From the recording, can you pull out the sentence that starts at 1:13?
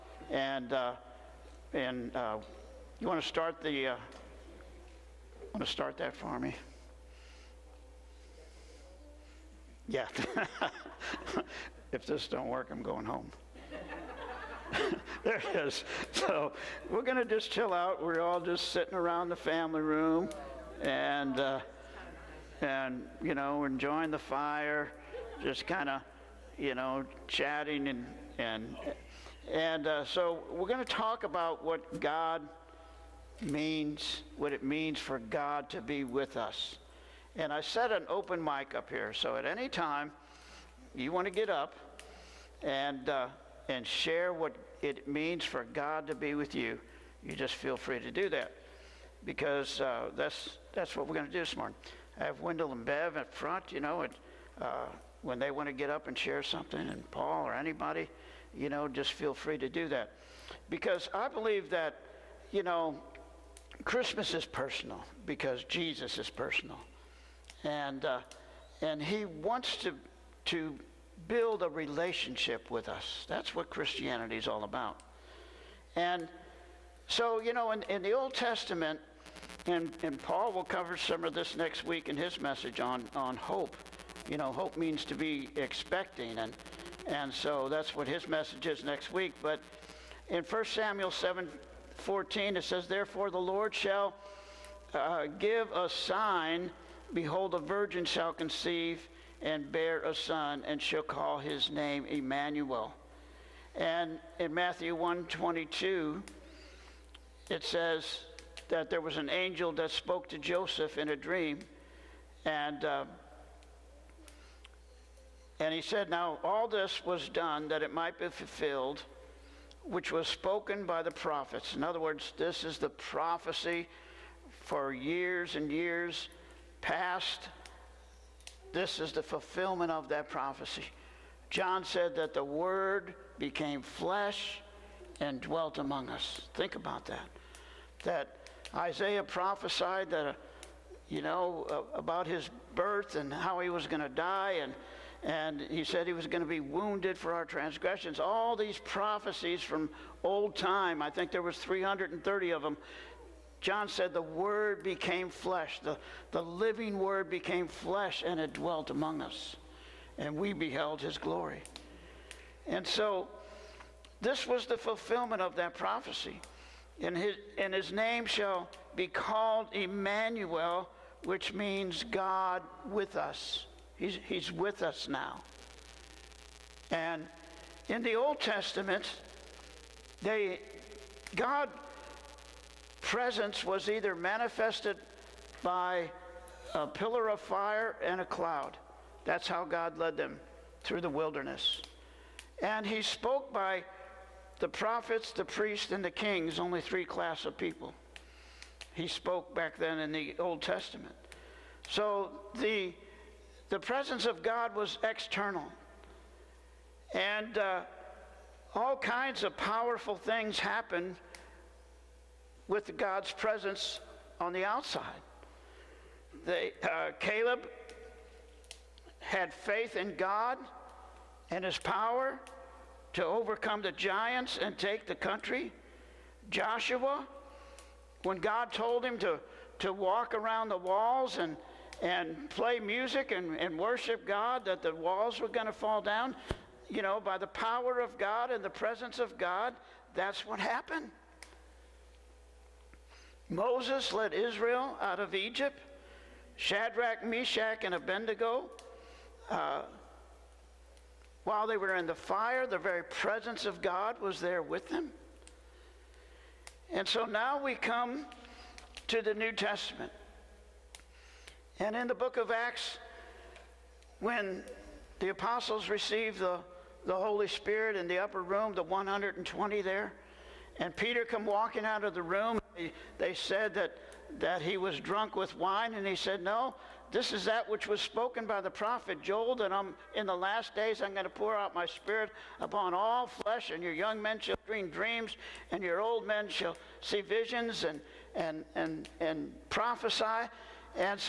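That's what Christianity is all about.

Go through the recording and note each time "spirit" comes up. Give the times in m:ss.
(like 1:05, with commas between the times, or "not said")
4:27, 4:41.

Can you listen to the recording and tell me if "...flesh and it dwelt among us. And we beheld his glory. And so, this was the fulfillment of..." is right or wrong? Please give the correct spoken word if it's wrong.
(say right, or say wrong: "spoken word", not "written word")
right.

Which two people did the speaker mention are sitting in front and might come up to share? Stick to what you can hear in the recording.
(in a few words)
Wendell and Bev.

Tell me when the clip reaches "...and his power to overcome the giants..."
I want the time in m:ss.
3:41.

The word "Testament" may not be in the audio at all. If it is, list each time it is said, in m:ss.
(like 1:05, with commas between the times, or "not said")
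1:18, 2:58, 3:20, 4:19.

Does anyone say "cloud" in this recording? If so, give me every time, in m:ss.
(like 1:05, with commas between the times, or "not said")
3:08.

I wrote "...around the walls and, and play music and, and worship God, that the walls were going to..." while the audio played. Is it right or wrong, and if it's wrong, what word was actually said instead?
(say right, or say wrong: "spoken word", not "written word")
right.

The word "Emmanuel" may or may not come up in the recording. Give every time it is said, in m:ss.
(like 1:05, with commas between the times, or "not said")
1:42, 2:49.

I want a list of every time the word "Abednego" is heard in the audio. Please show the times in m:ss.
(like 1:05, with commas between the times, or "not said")
4:07.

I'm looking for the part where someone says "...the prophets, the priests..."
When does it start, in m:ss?
3:14.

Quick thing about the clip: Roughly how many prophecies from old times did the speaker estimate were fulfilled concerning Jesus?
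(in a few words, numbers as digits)
330.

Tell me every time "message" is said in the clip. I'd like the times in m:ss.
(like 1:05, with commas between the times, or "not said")
1:22, 1:28.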